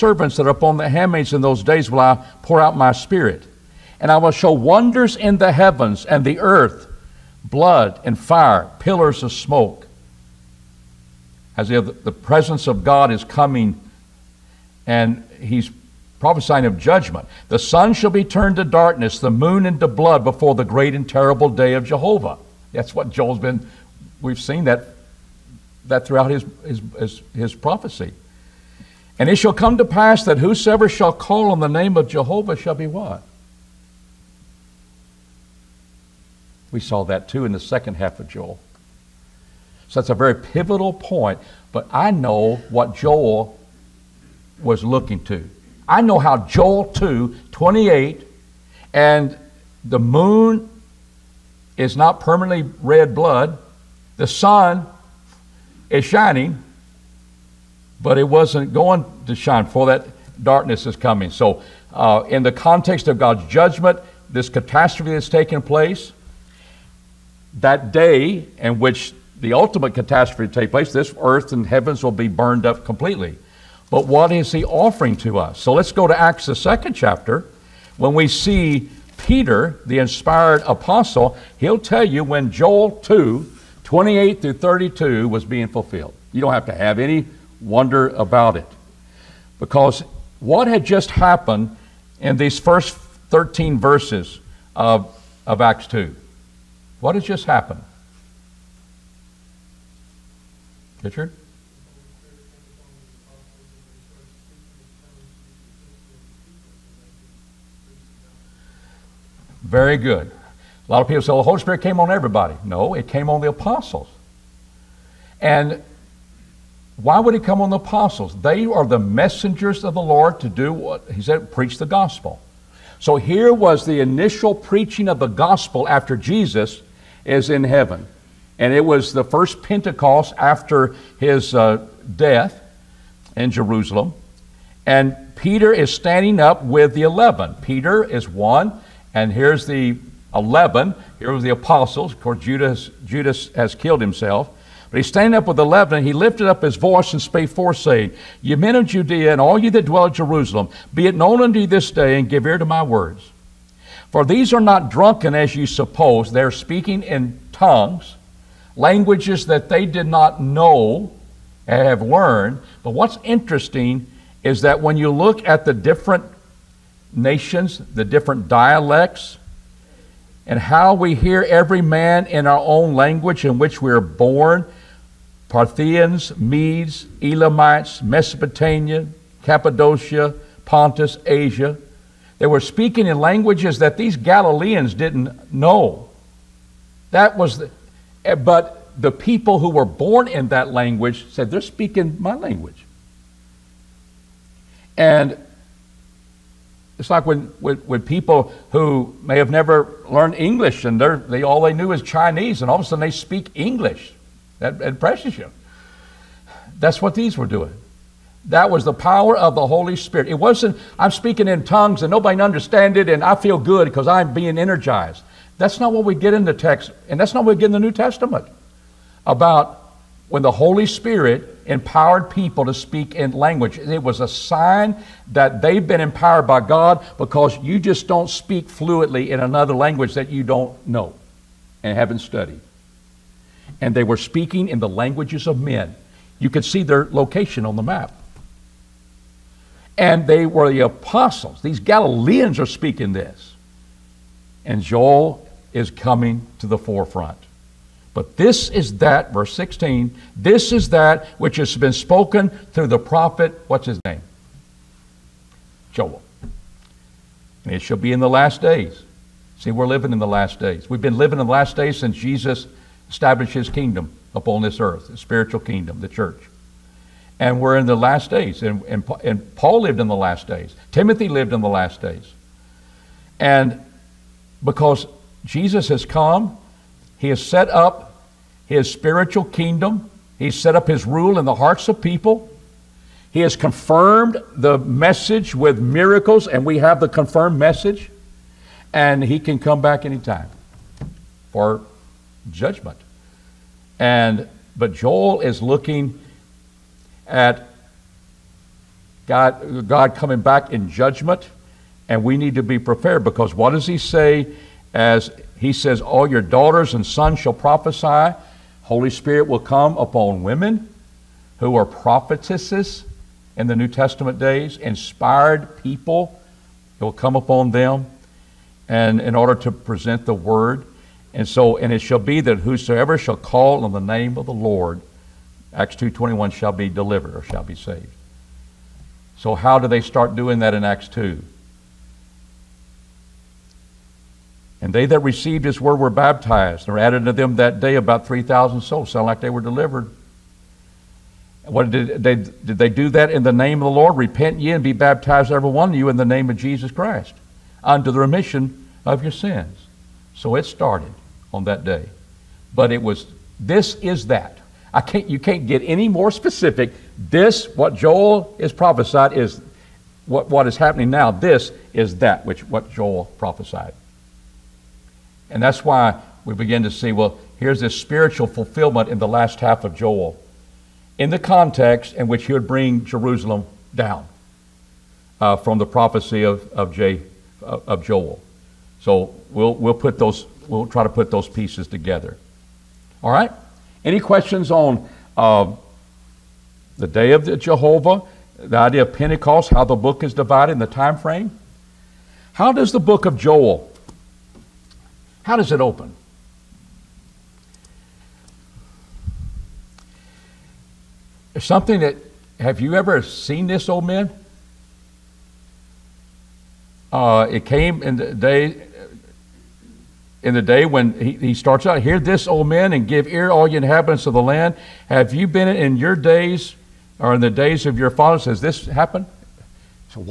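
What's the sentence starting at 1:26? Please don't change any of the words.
You don't have to have any wonder about it.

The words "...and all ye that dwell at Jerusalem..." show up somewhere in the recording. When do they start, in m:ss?
2:29.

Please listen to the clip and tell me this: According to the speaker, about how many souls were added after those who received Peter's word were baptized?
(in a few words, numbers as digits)
3,000.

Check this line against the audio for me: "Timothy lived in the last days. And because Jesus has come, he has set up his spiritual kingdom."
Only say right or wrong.
right.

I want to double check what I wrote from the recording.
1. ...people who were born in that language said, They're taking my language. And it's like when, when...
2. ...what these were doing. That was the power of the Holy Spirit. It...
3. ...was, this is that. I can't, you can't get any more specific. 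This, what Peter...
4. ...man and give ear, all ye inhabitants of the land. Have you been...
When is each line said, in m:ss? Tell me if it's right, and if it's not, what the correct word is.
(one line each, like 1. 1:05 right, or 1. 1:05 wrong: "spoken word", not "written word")
1. 3:09 wrong: "speaking", not "taking"
2. 3:27 right
3. 5:53 wrong: "Joel", not "Peter"
4. 6:52 right.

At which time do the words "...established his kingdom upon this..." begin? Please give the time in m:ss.
4:23.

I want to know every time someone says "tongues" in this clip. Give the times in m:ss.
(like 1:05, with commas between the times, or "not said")
2:37, 3:31.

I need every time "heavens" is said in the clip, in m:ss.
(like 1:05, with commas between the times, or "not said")
0:05, 1:11, 2:07.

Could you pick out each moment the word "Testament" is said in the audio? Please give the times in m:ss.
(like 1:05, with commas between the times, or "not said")
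3:37, 5:13.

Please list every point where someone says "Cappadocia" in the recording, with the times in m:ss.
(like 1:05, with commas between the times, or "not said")
2:59.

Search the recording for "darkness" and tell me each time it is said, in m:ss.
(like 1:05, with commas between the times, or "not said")
0:18, 1:00.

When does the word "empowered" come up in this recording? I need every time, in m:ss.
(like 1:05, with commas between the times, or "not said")
3:41, 3:46.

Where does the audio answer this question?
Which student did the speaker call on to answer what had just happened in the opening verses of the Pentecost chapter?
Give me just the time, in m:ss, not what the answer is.
1:41.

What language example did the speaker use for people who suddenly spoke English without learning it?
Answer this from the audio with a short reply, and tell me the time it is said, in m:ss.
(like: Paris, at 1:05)
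Chinese, at 3:22.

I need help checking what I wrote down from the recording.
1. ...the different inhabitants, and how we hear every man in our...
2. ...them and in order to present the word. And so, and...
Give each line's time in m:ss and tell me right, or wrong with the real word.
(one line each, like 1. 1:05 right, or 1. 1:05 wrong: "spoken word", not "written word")
1. 2:47 wrong: "dialects", not "inhabitants"
2. 5:17 right.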